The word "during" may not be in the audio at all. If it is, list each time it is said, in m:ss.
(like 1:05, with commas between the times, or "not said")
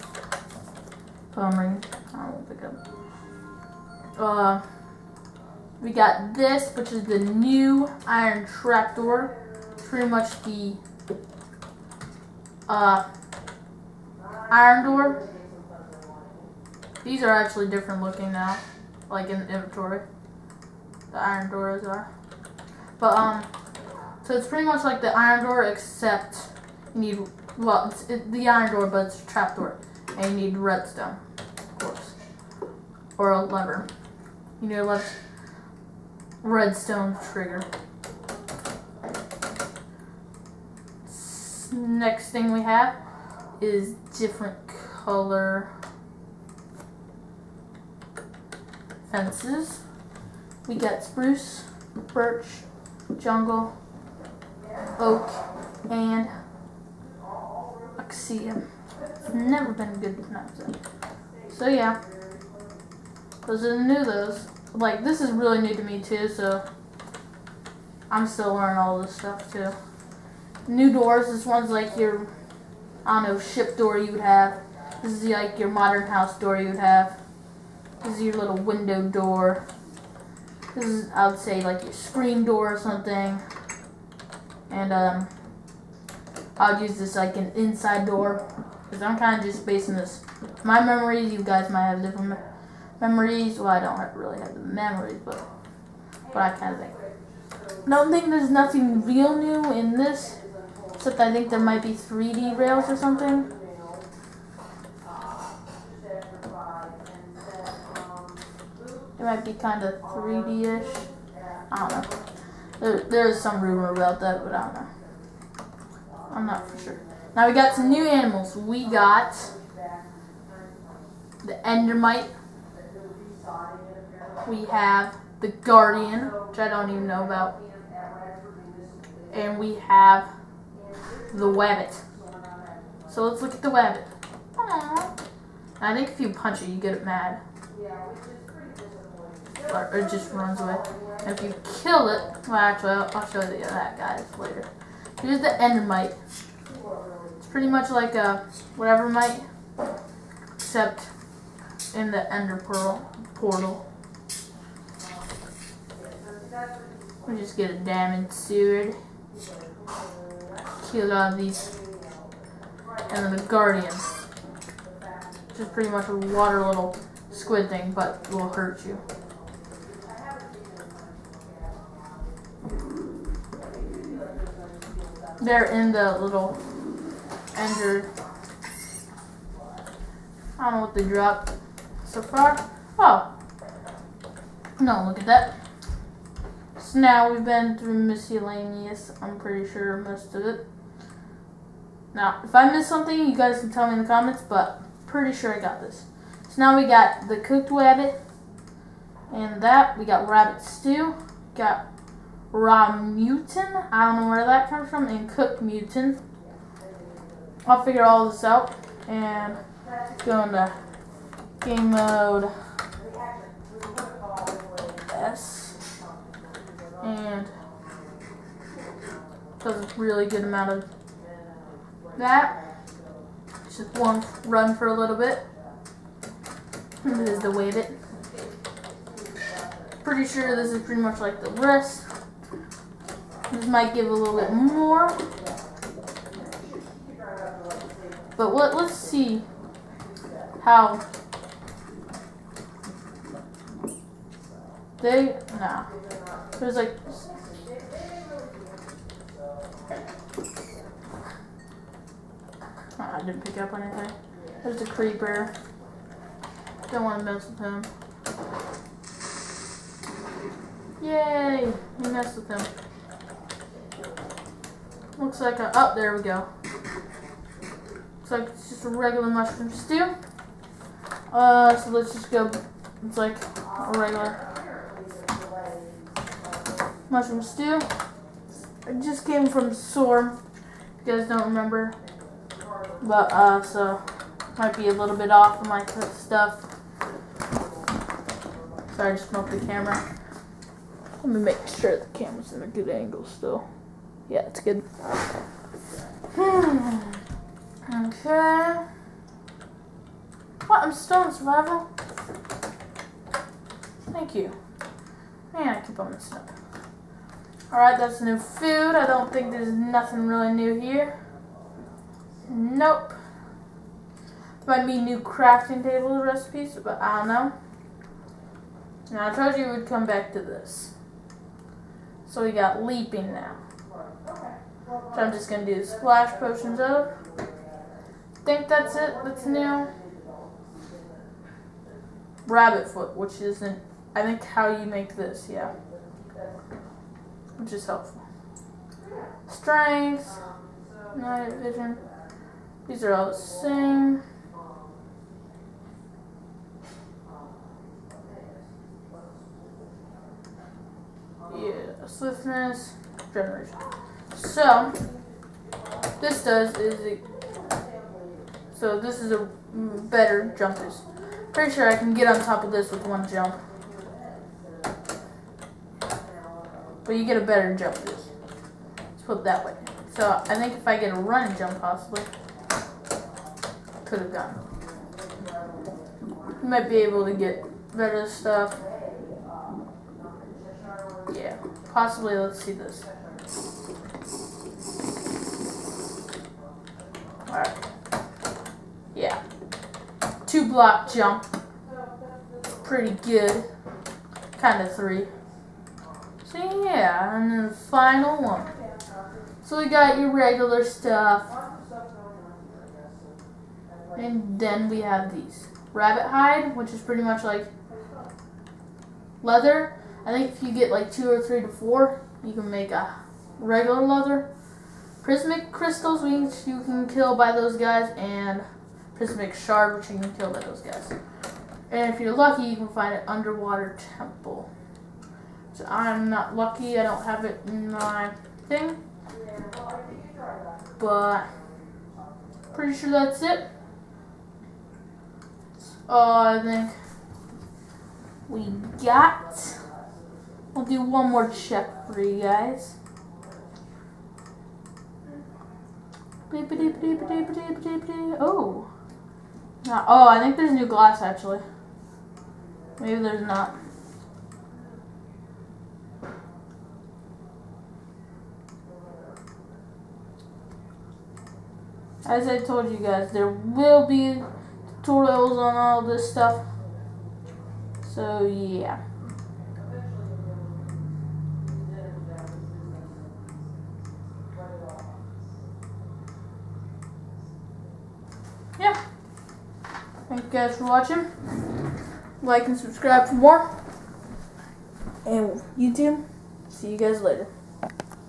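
not said.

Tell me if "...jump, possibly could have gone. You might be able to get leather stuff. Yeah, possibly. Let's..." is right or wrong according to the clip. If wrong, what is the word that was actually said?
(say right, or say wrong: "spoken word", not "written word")
wrong: "better", not "leather".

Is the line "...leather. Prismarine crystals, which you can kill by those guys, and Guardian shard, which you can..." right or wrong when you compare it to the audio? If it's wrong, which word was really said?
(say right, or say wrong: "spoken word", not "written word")
wrong: "Prismarine", not "Guardian".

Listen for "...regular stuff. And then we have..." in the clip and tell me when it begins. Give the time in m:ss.
6:40.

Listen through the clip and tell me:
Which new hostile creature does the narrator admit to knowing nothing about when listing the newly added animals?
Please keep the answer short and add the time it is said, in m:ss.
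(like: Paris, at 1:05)
Guardian, at 2:05.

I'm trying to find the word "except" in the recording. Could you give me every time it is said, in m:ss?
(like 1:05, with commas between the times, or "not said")
0:25, 1:40, 2:30.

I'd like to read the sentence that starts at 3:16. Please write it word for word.
So now we got the cooked rabbit, and that.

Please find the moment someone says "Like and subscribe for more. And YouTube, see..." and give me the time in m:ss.
8:02.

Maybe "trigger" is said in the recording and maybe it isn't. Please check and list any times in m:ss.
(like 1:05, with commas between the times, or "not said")
0:37.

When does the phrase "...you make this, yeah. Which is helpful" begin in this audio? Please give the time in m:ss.
5:34.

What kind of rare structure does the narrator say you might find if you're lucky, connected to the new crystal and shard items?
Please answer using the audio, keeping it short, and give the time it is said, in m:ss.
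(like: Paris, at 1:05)
Underwater temple, at 7:03.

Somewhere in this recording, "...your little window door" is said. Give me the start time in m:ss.
1:18.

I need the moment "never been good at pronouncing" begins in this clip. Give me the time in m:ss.
0:59.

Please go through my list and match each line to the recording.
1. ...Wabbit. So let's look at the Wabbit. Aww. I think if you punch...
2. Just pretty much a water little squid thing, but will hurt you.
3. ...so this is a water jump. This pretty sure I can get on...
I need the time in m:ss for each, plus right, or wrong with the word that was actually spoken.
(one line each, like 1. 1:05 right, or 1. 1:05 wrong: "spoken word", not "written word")
1. 2:11 right
2. 2:45 right
3. 5:58 wrong: "better", not "water".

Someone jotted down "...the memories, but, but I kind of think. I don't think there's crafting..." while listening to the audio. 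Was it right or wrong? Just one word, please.
wrong.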